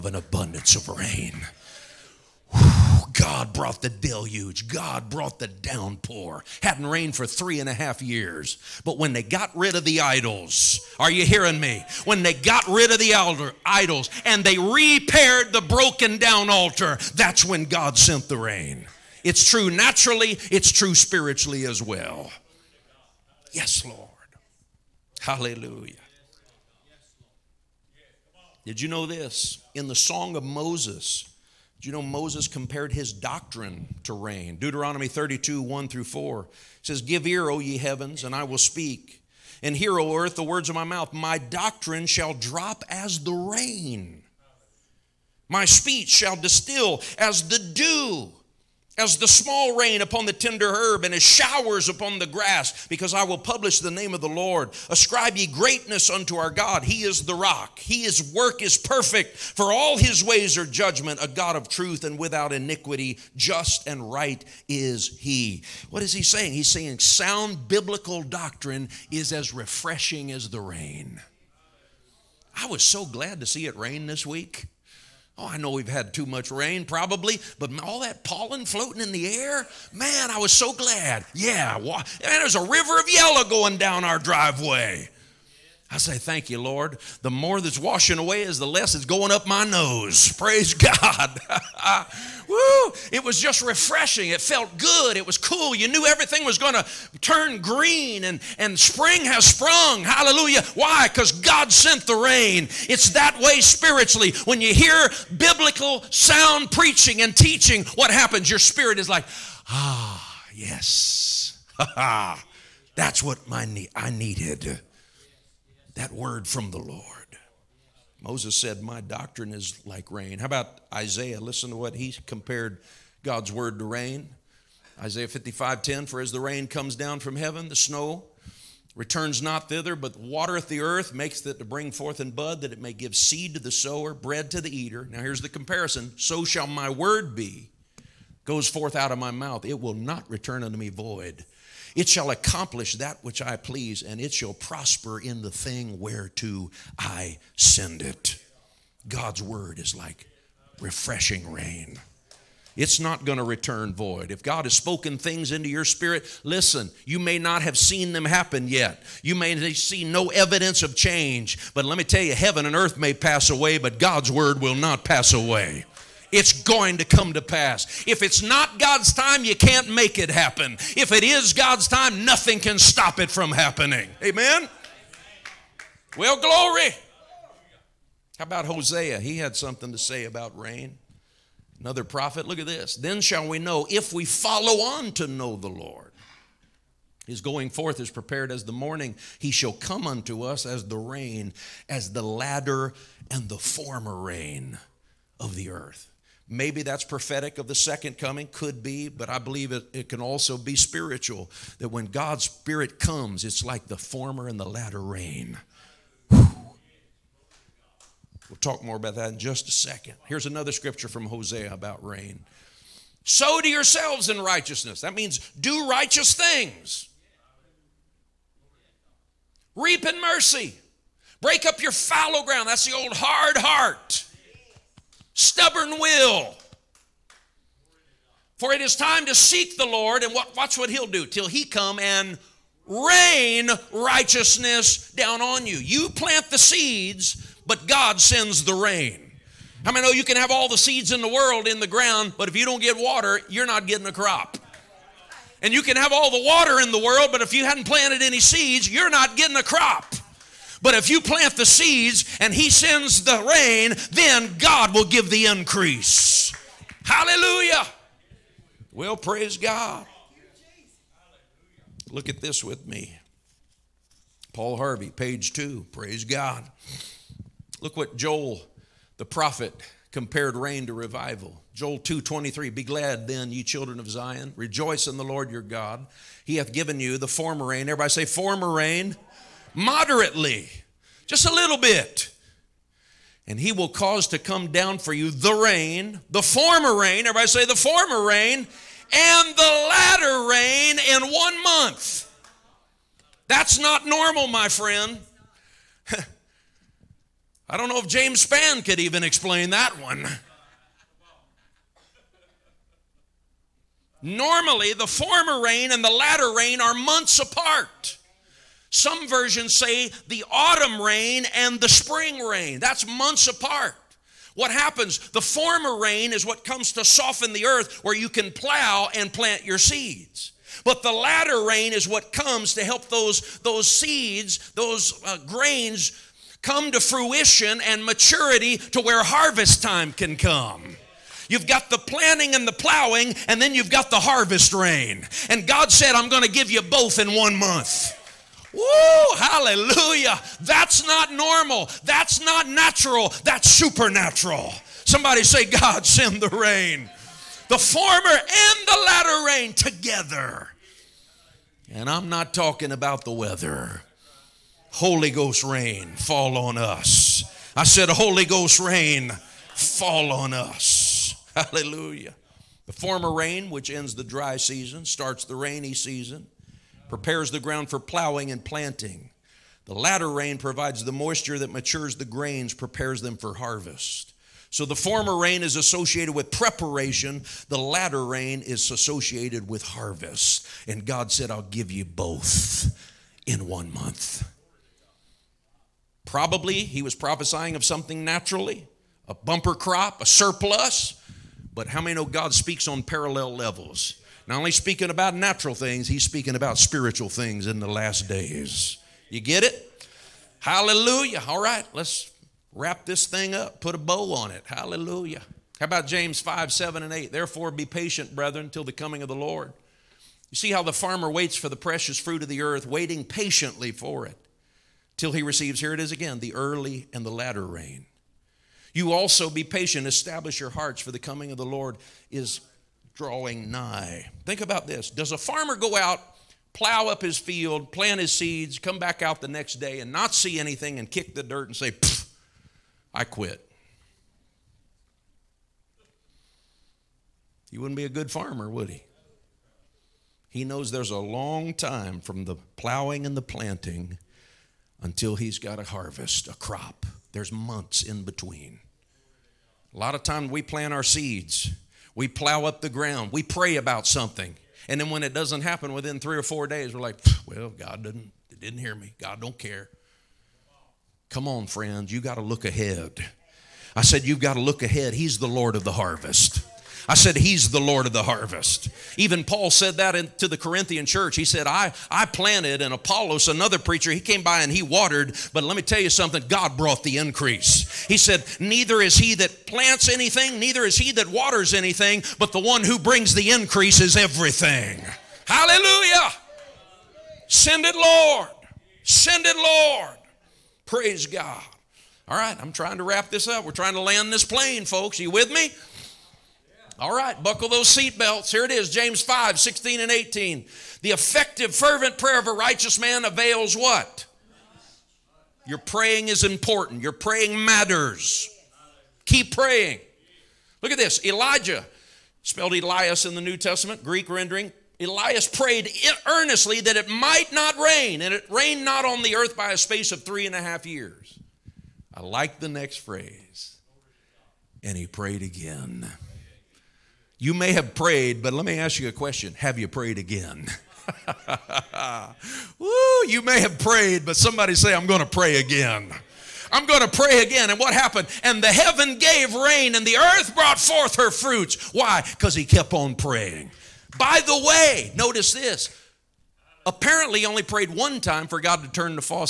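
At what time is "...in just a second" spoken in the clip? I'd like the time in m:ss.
3:29.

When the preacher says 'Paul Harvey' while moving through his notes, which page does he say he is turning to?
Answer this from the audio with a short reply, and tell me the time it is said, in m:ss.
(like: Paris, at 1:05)
Page 2, at 4:25.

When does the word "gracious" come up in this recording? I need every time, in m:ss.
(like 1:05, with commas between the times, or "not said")
not said.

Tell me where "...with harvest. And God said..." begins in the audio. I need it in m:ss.
6:19.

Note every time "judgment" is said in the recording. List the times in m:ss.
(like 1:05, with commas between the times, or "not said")
1:00.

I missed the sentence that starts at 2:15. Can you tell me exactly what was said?
Now here's the comparison So shall my word be, goes forth out of my mouth.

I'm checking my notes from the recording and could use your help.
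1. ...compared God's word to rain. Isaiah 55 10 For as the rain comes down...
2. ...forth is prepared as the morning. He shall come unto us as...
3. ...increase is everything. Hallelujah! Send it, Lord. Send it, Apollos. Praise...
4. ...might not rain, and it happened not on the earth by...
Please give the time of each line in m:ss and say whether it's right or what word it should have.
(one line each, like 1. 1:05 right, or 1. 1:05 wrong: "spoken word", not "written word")
1. 2:02 right
2. 3:07 right
3. 8:03 wrong: "Lord", not "Apollos"
4. 8:37 wrong: "rained", not "happened".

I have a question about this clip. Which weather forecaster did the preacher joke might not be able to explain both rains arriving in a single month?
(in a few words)
James Spann.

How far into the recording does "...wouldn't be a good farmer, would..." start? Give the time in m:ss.
7:17.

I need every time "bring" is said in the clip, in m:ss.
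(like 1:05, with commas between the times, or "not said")
2:11, 8:02.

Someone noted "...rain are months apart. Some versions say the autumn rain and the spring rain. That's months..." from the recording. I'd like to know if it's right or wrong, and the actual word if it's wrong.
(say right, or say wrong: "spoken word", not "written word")
right.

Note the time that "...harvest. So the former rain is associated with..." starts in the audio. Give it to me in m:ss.
6:13.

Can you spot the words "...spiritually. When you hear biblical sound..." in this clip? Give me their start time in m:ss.
1:43.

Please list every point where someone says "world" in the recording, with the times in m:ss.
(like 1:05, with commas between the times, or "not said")
4:01, 4:06.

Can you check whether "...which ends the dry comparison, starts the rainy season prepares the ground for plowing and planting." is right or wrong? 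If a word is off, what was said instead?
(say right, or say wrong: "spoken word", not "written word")
wrong: "season", not "comparison".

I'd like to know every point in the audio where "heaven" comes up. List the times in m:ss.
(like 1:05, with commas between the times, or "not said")
0:37, 2:07, 2:42, 8:58.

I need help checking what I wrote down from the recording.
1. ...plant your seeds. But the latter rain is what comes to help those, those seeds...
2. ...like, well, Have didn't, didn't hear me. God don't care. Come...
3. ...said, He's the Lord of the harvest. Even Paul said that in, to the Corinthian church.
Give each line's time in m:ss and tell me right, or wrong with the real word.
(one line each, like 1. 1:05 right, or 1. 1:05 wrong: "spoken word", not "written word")
1. 5:19 right
2. 7:37 wrong: "God", not "Have"
3. 7:47 right.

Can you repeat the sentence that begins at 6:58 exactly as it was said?
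You also be patient, establish your hearts, for the coming of the Lord is drawing nigh.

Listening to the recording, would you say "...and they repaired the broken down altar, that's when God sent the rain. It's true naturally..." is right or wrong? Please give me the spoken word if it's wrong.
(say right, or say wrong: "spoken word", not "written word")
right.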